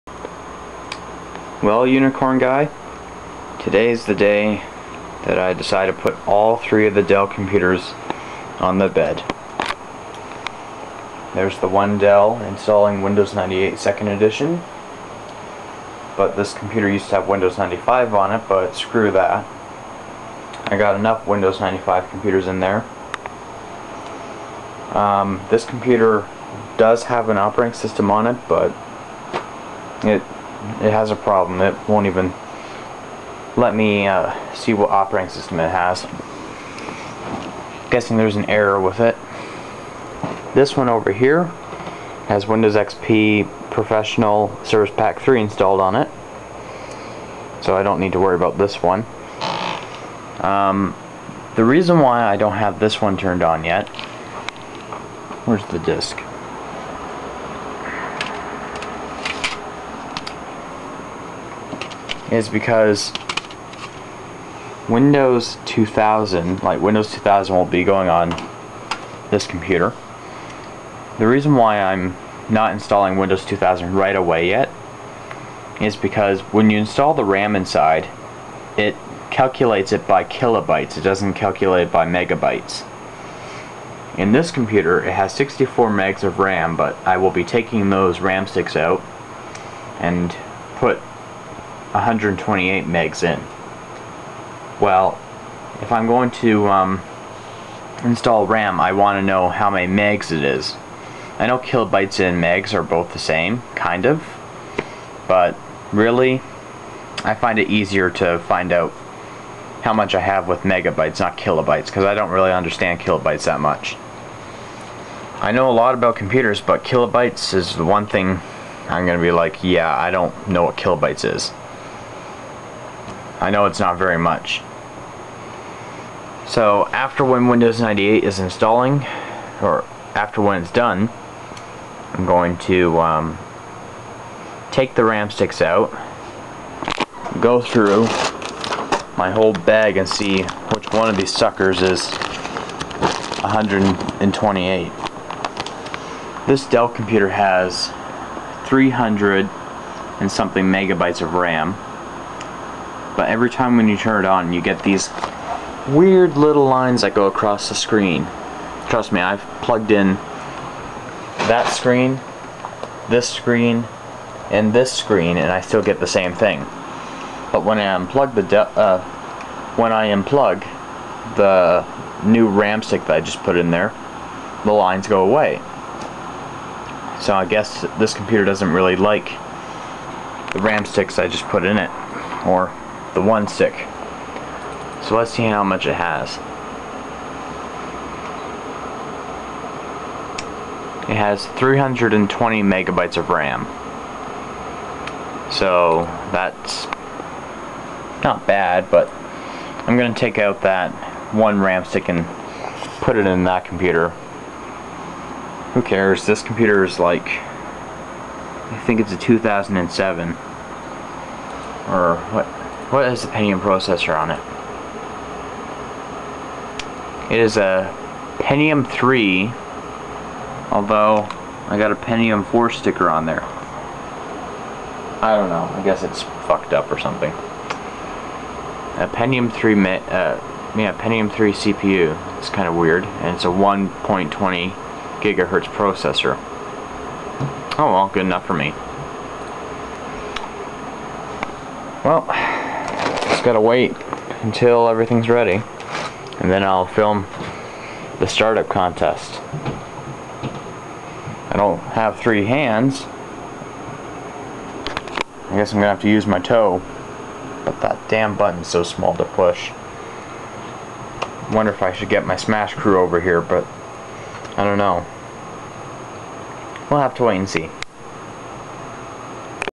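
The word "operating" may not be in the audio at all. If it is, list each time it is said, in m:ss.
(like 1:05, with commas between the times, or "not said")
0:27, 0:34.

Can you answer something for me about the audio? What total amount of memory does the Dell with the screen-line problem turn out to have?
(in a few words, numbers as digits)
320 megabytes.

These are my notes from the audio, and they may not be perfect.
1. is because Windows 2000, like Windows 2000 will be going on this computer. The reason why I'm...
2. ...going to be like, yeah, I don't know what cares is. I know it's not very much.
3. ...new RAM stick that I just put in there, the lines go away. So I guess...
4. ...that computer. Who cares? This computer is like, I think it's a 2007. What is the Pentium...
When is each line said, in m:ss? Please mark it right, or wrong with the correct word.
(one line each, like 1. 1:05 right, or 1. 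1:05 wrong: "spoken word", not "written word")
1. 1:02 right
2. 1:59 wrong: "kilobytes", not "cares"
3. 2:52 right
4. 3:23 right.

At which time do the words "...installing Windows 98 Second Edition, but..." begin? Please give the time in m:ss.
0:12.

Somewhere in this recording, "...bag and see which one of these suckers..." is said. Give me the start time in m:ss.
2:19.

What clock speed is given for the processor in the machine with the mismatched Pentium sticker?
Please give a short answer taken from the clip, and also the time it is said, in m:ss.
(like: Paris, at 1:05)
1.20 gigahertz, at 3:53.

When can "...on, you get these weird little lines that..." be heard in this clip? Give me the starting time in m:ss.
2:34.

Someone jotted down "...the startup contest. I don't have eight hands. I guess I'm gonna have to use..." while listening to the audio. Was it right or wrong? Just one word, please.
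wrong.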